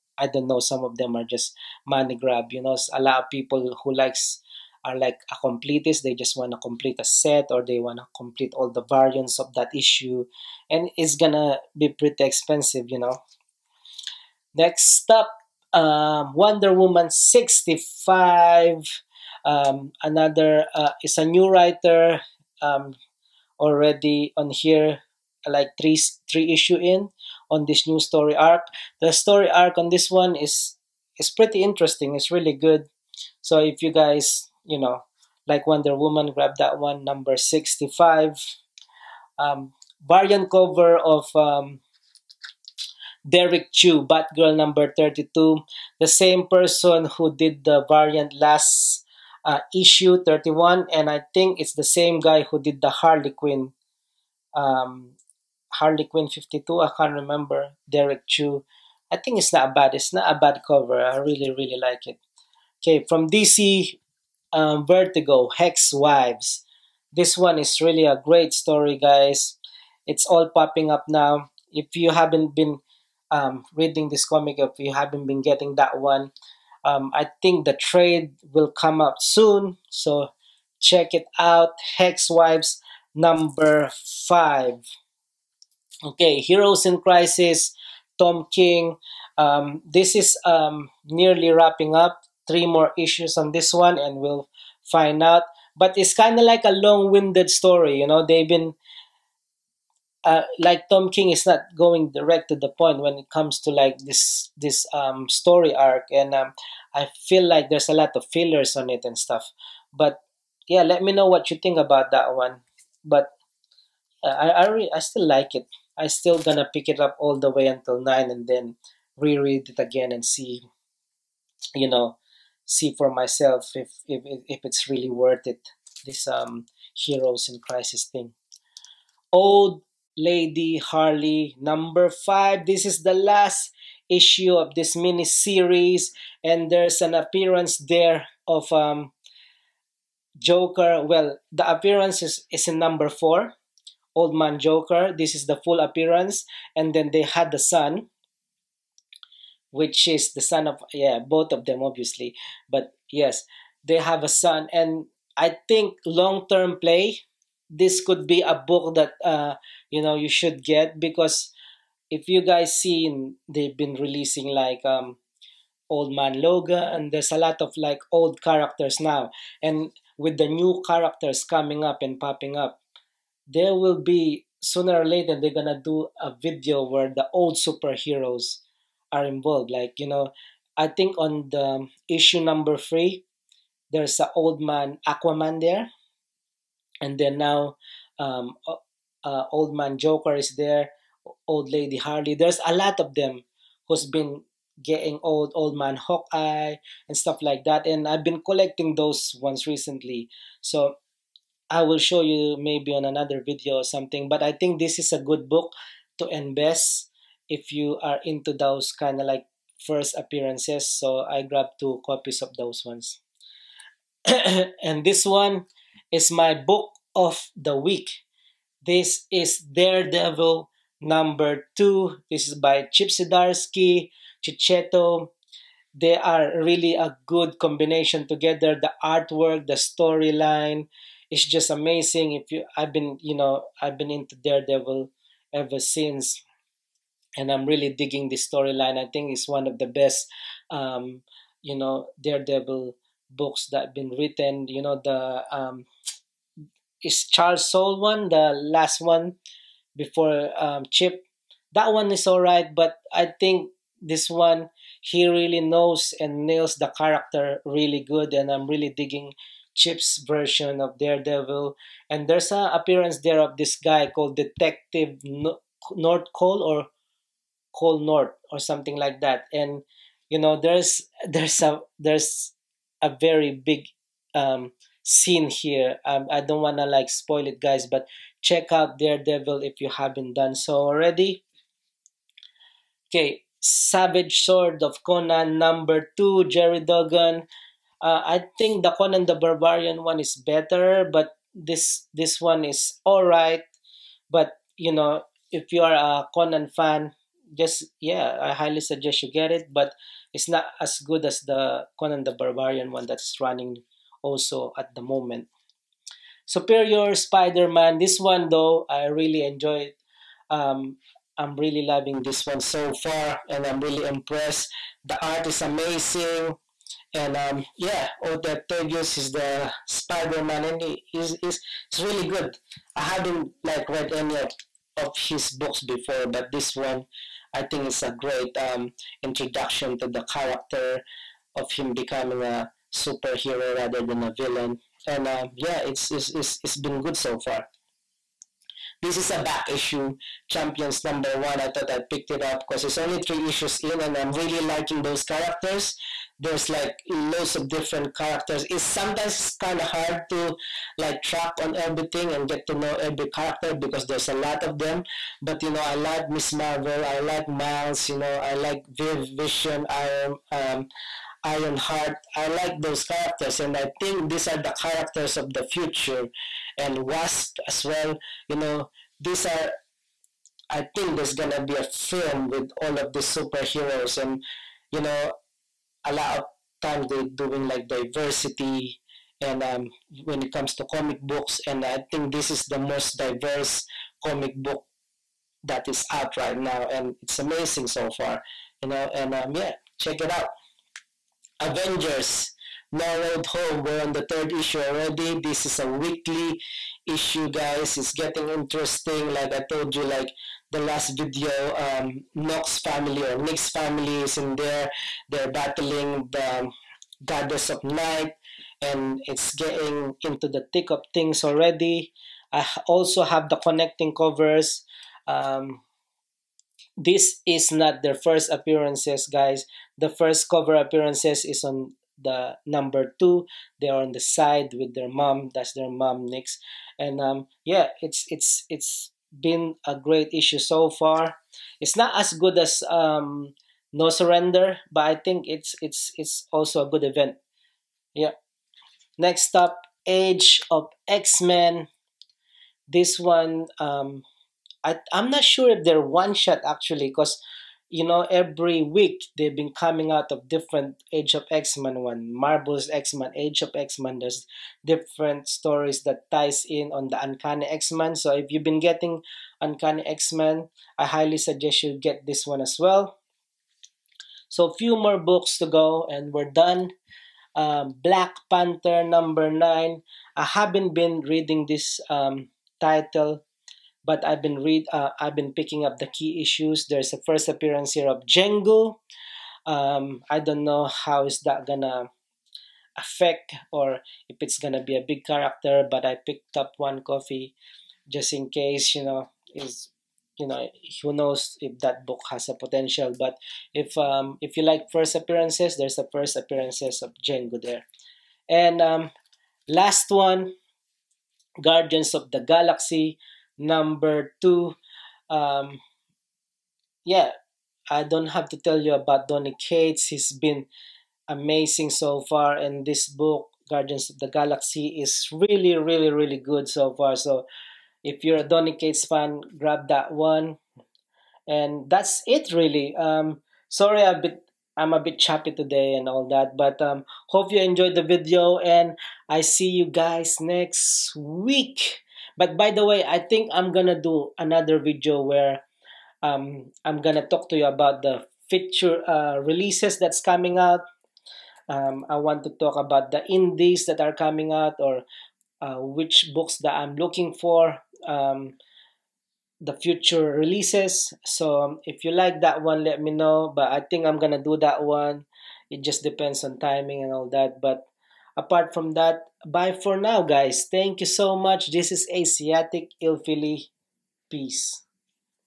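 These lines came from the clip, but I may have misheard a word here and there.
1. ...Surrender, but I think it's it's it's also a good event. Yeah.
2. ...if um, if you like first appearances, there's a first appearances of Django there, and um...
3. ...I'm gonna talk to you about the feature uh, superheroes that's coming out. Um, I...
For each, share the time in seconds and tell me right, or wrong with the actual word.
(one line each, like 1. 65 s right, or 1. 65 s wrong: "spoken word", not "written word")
1. 434 s right
2. 493 s right
3. 536 s wrong: "releases", not "superheroes".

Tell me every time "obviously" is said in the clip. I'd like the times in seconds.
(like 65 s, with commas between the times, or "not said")
151 s.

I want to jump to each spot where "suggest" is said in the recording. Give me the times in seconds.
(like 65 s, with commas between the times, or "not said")
298 s, 461 s.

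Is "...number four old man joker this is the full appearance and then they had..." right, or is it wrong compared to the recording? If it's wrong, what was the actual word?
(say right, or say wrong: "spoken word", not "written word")
right.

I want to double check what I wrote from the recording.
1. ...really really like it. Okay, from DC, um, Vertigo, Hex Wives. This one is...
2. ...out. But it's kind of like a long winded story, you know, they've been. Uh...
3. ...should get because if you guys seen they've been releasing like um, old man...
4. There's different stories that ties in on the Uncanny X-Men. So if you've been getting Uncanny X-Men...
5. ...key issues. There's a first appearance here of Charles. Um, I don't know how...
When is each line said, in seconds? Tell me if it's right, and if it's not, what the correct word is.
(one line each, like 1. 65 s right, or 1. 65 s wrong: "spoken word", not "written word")
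1. 61 s right
2. 95 s right
3. 160 s right
4. 454 s right
5. 476 s wrong: "Django", not "Charles".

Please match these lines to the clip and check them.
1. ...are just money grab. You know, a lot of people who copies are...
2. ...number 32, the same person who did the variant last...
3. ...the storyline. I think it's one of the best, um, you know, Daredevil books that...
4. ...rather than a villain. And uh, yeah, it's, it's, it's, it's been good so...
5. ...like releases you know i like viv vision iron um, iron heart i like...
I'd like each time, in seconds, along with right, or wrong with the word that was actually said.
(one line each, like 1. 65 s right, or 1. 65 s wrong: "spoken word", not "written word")
1. 1 s wrong: "likes", not "copies"
2. 44 s right
3. 238 s right
4. 333 s right
5. 357 s wrong: "miles", not "releases".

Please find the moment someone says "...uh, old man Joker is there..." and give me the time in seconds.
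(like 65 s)
189 s.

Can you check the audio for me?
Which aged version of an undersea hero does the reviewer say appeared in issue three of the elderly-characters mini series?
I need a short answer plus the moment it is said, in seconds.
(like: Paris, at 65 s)
Old man Aquaman, at 184 s.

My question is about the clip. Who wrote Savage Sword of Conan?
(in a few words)
Gerry Duggan.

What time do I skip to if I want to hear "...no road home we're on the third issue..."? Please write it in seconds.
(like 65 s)
392 s.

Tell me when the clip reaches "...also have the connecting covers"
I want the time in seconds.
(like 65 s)
412 s.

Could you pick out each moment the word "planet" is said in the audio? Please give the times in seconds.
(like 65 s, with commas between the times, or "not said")
not said.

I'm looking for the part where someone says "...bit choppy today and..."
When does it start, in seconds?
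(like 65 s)
525 s.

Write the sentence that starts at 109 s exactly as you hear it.
But yeah, let me know what you think about that one.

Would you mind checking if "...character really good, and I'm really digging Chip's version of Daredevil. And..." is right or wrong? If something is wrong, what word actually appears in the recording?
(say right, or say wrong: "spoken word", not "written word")
right.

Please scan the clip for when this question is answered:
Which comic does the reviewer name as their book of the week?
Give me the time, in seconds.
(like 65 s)
219 s.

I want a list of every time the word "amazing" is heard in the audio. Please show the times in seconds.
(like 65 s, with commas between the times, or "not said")
231 s, 315 s, 387 s, 511 s.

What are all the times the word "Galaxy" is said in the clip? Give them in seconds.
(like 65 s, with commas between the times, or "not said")
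502 s, 514 s.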